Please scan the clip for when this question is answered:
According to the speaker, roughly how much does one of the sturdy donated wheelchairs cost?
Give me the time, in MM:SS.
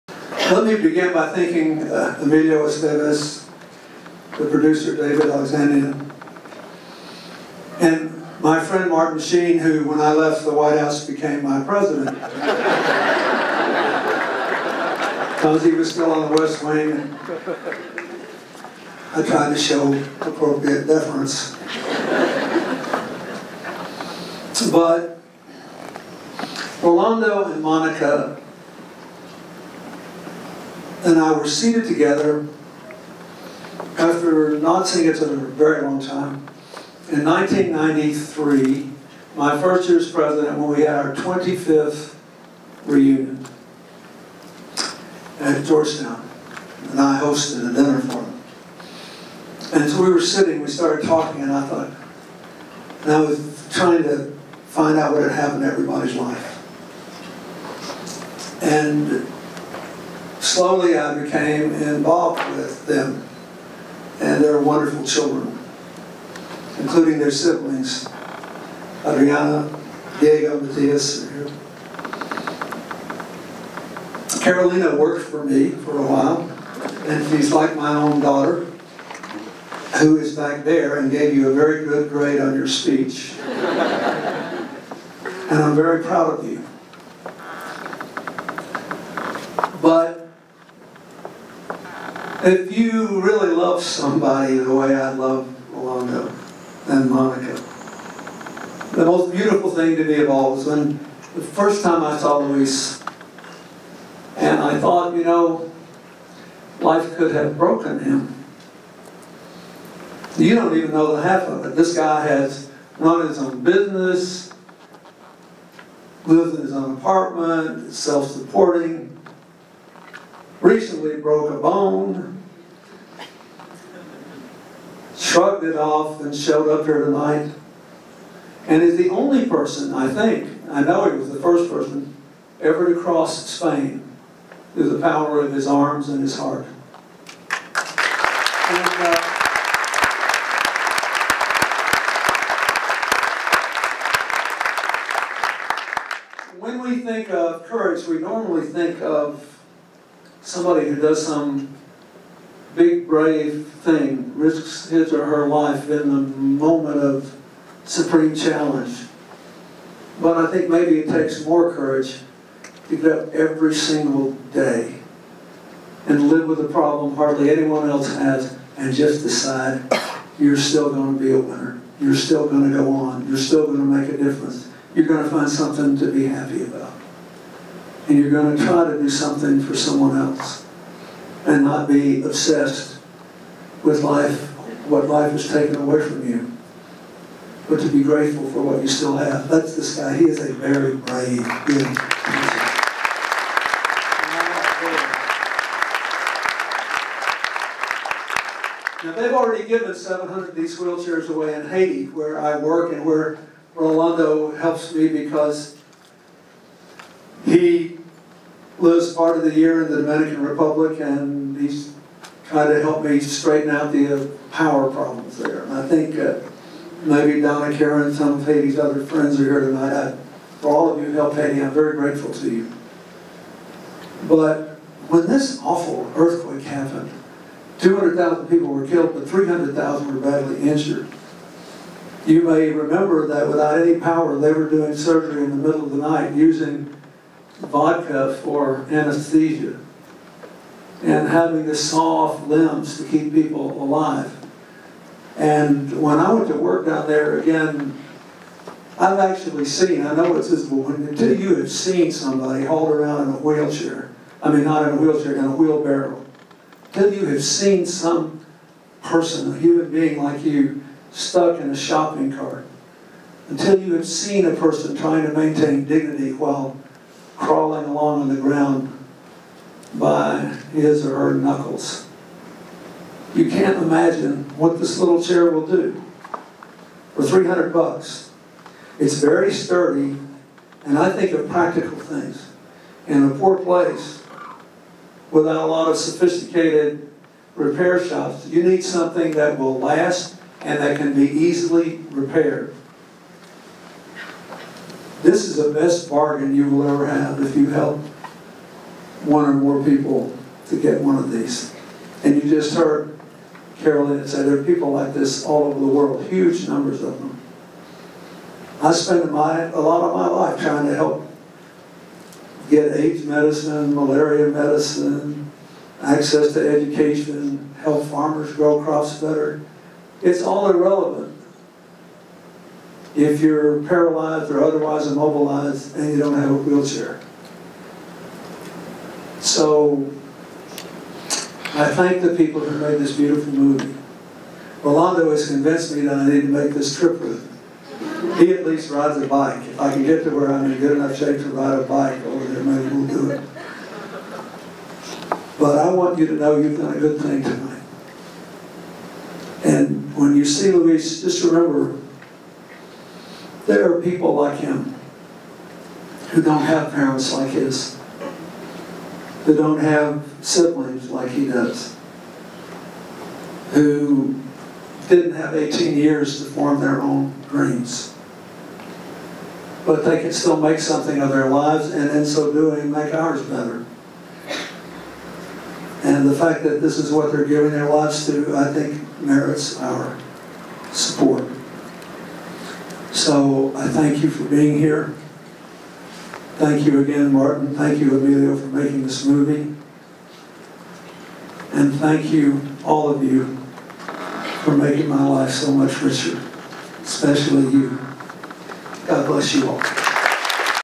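04:37.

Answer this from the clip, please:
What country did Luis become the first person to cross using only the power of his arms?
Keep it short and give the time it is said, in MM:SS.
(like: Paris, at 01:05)
Spain, at 02:13.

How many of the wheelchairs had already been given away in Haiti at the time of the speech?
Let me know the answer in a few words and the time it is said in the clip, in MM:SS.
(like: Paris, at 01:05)
700, at 03:19.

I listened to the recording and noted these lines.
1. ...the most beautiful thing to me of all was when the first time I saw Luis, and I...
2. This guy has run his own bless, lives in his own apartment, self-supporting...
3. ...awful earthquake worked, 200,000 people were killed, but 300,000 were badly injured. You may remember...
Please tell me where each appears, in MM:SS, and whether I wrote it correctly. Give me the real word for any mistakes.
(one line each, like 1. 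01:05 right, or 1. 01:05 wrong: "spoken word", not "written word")
1. 01:38 right
2. 01:51 wrong: "business", not "bless"
3. 03:45 wrong: "happened", not "worked".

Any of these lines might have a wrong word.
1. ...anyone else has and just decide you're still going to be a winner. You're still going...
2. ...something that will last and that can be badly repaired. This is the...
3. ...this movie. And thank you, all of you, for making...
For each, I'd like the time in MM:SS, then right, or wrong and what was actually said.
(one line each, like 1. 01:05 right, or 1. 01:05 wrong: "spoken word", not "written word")
1. 02:47 right
2. 04:48 wrong: "easily", not "badly"
3. 06:29 right.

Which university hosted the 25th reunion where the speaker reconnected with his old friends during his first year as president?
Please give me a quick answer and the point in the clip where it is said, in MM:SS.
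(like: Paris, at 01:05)
Georgetown, at 00:45.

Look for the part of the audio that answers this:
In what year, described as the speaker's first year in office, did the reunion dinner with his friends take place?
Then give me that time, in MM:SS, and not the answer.
00:37.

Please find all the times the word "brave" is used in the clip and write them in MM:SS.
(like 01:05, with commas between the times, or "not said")
02:33, 03:10.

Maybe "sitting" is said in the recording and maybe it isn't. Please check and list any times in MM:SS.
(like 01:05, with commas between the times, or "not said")
00:50.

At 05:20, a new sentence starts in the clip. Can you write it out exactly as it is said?
It's all irrelevant if you're paralyzed or otherwise immobilized and you don't have a wheelchair.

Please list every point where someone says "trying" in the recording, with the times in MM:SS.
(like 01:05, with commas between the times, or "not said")
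00:53, 04:24, 05:10.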